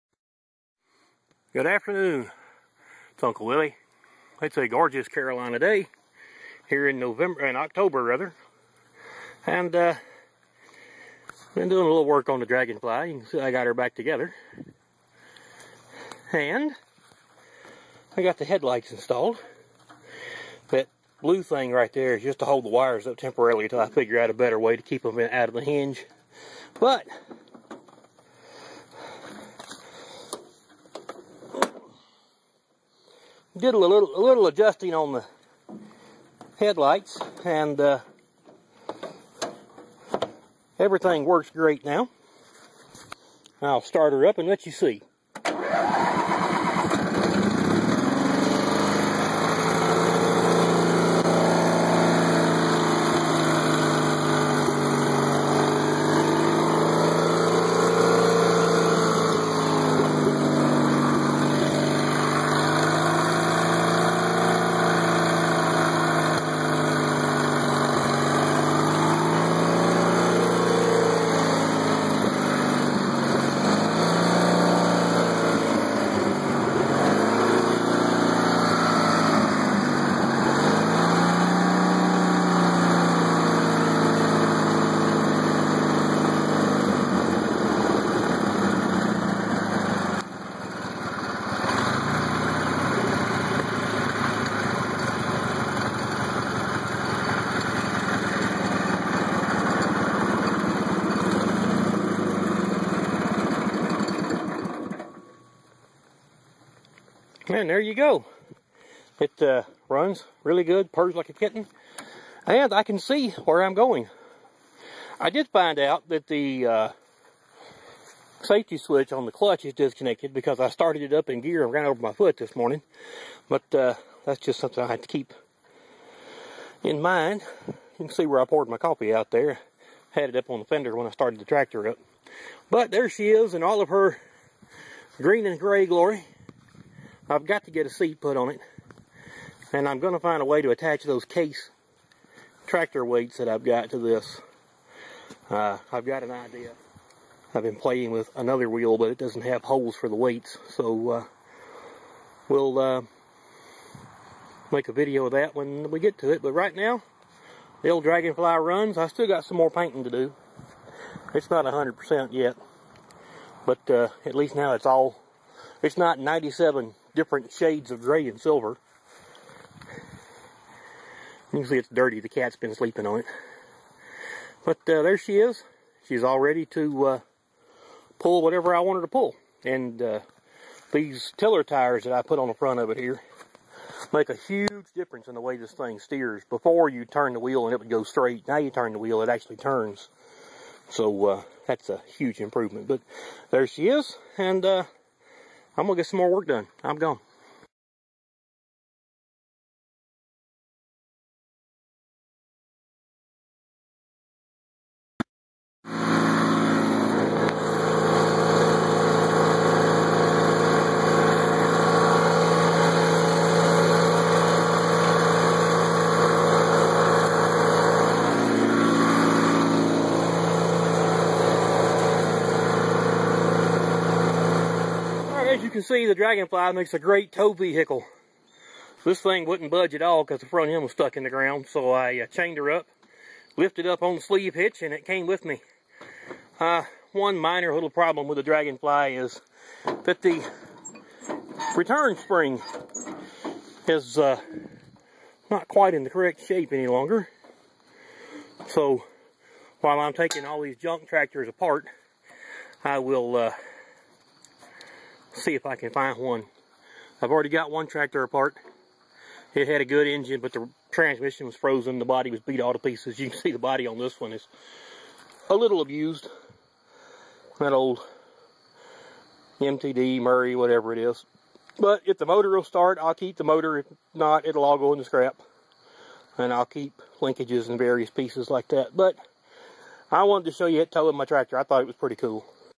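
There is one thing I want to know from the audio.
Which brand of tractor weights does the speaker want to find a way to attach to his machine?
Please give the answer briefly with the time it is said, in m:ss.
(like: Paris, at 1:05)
Case, at 2:21.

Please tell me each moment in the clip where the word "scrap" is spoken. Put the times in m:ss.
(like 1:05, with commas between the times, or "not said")
4:35.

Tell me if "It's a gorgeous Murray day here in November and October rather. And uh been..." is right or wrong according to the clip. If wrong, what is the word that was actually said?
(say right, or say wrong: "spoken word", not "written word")
wrong: "Carolina", not "Murray".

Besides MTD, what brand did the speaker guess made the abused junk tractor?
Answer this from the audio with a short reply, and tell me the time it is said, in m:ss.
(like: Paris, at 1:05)
Murray, at 4:30.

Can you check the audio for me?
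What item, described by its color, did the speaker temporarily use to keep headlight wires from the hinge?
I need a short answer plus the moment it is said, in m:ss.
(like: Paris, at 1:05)
blue thing, at 0:21.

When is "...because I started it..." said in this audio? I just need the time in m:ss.
2:00.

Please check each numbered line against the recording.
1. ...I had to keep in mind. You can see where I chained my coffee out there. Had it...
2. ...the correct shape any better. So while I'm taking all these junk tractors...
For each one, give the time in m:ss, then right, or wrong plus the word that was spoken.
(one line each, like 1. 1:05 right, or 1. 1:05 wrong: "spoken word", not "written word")
1. 2:04 wrong: "poured", not "chained"
2. 4:06 wrong: "longer", not "better".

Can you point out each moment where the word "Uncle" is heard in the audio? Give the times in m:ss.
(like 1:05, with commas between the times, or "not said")
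0:03.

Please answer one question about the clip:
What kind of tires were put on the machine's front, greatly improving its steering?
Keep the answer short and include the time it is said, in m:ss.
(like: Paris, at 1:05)
tiller tires, at 3:01.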